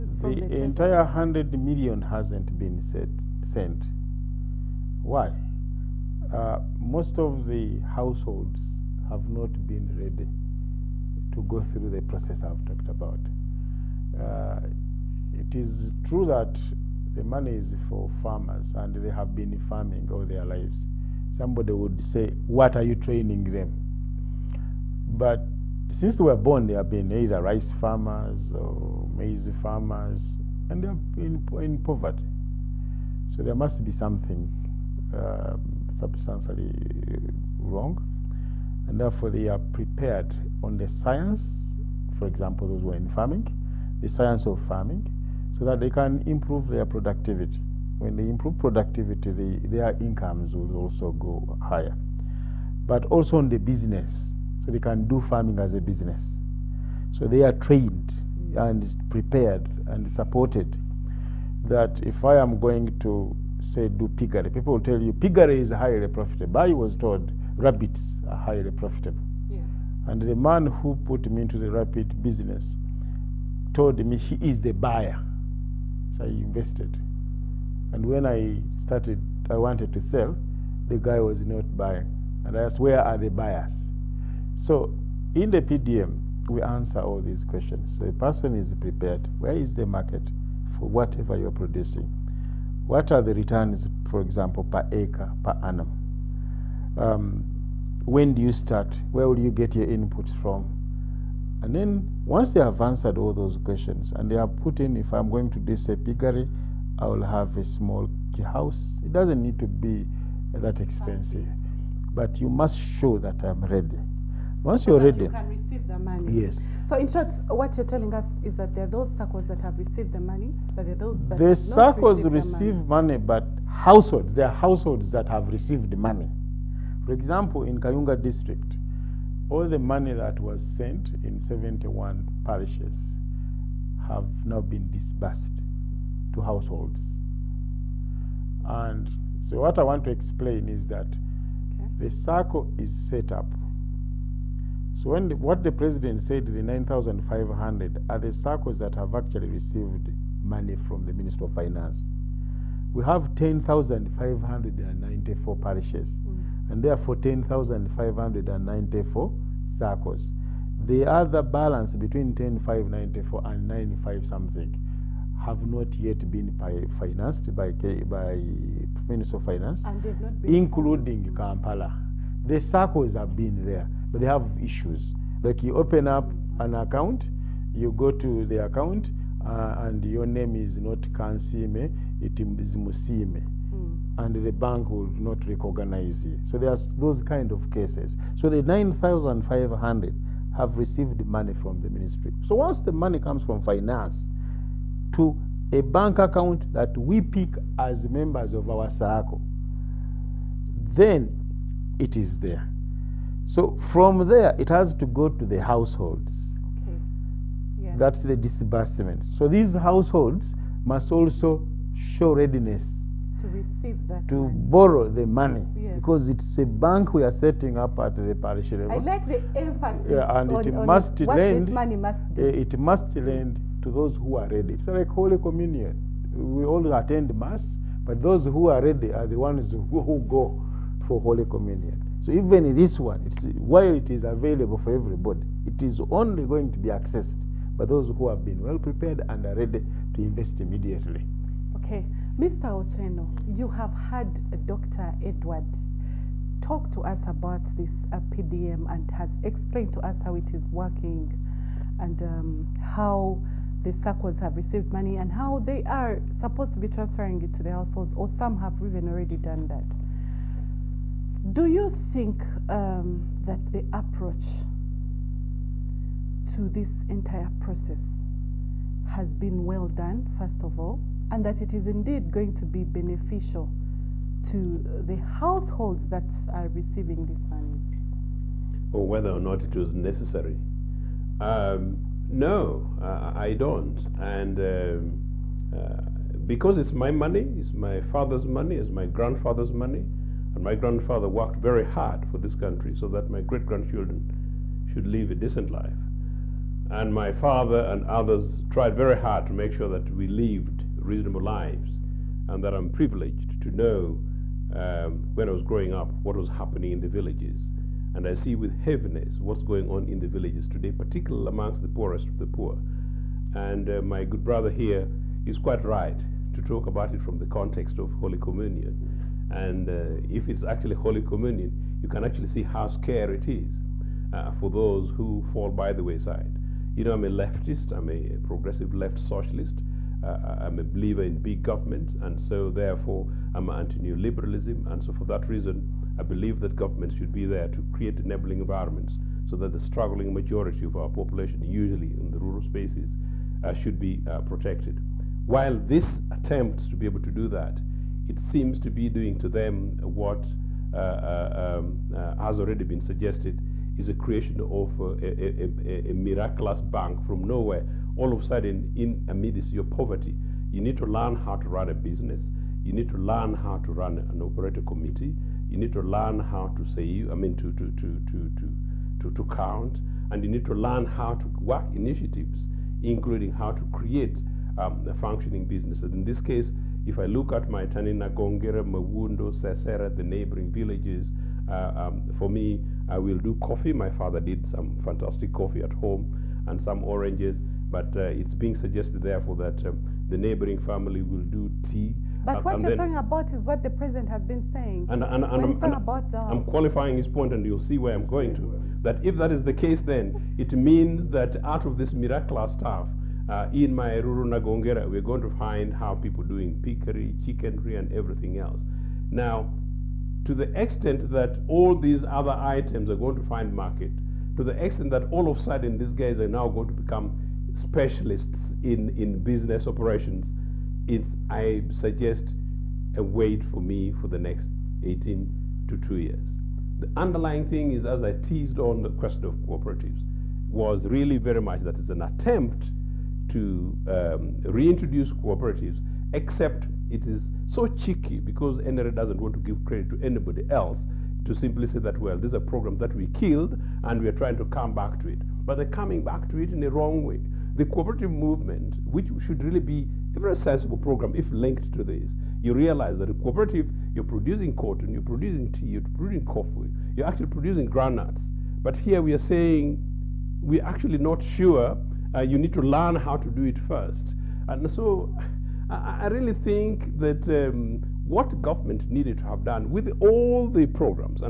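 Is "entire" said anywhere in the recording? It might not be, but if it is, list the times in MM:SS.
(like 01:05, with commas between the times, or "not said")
00:00, 04:27.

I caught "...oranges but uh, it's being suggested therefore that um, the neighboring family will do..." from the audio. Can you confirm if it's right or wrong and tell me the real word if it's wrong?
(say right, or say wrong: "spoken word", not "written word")
right.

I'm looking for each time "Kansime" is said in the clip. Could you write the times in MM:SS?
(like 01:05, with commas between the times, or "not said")
03:01.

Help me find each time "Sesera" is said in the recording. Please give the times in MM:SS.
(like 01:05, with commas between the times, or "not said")
06:19.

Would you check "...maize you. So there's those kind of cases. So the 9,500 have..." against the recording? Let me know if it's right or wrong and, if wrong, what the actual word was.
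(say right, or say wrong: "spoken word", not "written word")
wrong: "recognize", not "maize".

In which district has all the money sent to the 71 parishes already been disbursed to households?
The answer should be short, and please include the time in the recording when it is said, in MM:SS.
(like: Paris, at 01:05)
Kayunga, at 02:07.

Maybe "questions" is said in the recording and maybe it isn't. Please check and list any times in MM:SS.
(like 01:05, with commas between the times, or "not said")
01:27, 01:43, 07:09.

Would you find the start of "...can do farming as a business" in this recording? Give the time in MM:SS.
00:54.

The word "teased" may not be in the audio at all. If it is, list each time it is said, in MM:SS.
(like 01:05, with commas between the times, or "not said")
07:08.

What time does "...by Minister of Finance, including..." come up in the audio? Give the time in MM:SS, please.
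02:48.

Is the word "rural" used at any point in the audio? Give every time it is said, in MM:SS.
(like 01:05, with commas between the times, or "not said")
05:42, 06:44.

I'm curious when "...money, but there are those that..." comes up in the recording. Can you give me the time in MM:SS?
02:00.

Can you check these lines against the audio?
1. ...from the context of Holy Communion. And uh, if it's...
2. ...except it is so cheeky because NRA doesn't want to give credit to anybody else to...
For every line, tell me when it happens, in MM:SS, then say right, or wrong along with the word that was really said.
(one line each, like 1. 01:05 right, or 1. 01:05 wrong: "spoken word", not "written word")
1. 05:17 right
2. 07:16 right.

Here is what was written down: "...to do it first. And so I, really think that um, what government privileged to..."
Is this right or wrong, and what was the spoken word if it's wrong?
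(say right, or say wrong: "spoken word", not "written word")
wrong: "needed", not "privileged".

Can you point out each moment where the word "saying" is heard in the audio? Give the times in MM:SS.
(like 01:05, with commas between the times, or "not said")
06:34, 07:39.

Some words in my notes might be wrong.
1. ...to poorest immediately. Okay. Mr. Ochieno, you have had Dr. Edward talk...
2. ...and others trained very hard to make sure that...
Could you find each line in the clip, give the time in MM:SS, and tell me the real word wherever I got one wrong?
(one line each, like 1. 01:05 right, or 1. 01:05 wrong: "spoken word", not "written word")
1. 04:00 wrong: "invest", not "poorest"
2. 04:57 wrong: "tried", not "trained".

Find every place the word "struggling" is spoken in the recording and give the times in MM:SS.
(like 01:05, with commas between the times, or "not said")
05:39.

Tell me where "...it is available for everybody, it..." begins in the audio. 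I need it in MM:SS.
03:53.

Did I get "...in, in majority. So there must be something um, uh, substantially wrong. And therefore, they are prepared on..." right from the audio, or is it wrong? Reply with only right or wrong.
wrong.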